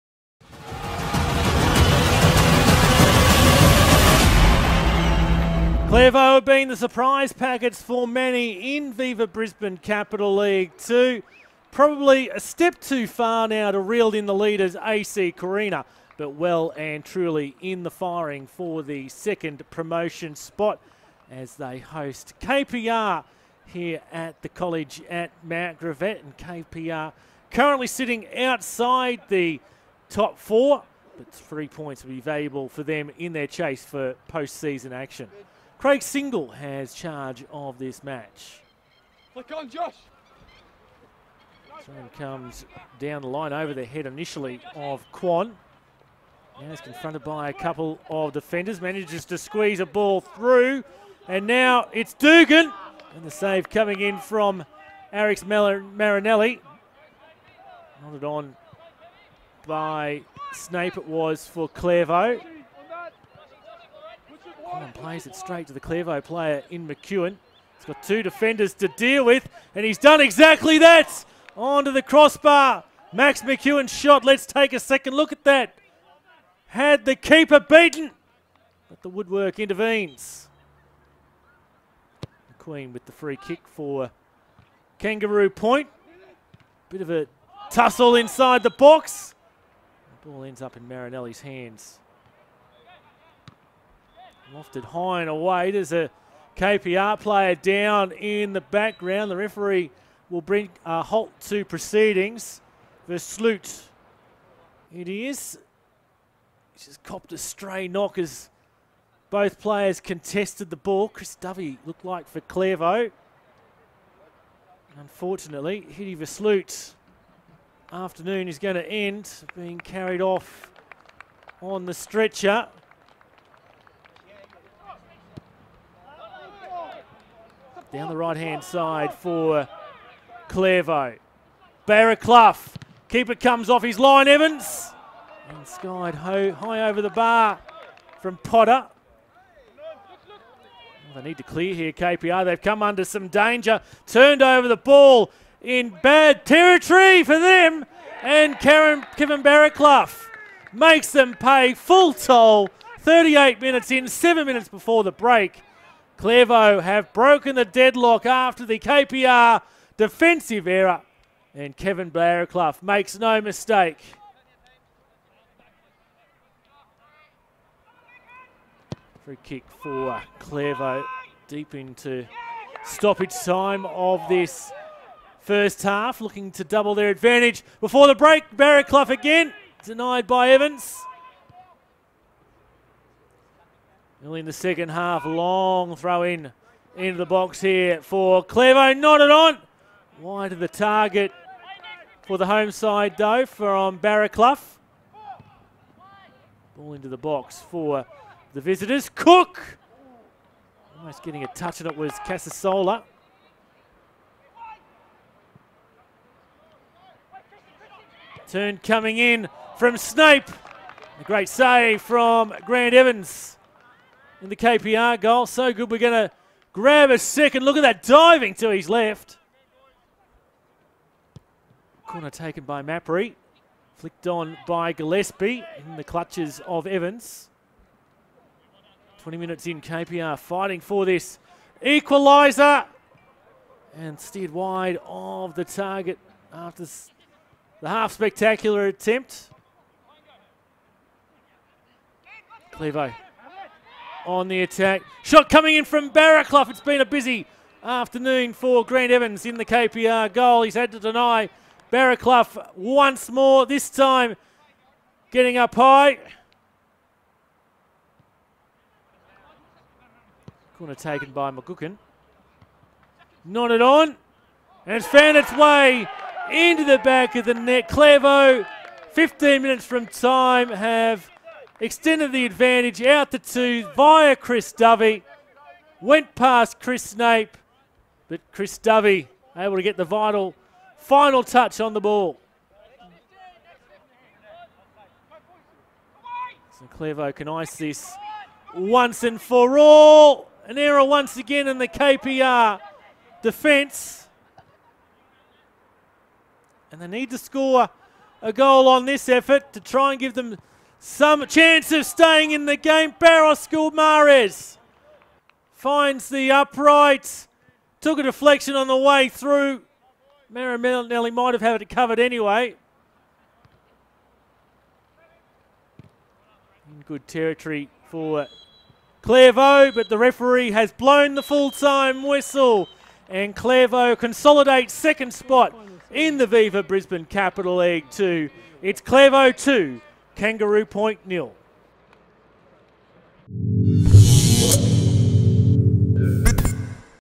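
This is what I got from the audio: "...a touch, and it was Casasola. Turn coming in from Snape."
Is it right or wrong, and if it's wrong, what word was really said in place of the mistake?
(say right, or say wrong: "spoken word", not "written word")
right.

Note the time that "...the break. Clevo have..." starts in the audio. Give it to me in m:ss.
2:35.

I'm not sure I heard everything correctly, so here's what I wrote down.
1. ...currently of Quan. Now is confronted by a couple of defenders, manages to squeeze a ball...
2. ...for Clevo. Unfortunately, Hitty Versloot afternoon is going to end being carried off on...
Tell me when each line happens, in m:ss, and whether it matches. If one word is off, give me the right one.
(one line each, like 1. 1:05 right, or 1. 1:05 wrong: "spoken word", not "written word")
1. 0:44 wrong: "initially", not "currently"
2. 1:52 right.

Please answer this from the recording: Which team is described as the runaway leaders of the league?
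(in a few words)
AC Carina.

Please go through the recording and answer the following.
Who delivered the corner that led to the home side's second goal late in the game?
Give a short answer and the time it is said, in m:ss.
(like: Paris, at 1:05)
McGookin, at 4:21.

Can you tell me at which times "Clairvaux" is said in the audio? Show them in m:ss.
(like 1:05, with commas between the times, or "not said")
1:01, 2:10, 5:19, 5:23, 5:29.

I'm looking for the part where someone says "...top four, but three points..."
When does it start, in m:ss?
0:30.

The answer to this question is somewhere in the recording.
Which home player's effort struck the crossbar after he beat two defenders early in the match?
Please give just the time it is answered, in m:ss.
1:13.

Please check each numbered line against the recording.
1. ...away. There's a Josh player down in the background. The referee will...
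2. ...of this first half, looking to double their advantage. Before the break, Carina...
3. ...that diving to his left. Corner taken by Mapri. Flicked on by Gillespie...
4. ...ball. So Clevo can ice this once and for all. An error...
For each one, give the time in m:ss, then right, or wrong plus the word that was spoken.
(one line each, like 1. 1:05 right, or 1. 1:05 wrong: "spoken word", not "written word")
1. 1:35 wrong: "KPR", not "Josh"
2. 2:53 wrong: "Barraclough", not "Carina"
3. 3:37 right
4. 4:41 right.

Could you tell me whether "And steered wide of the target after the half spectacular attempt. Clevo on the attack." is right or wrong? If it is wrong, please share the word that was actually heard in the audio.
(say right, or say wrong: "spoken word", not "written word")
right.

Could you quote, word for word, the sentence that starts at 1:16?
Had the keeper beaten, but the woodwork intervenes.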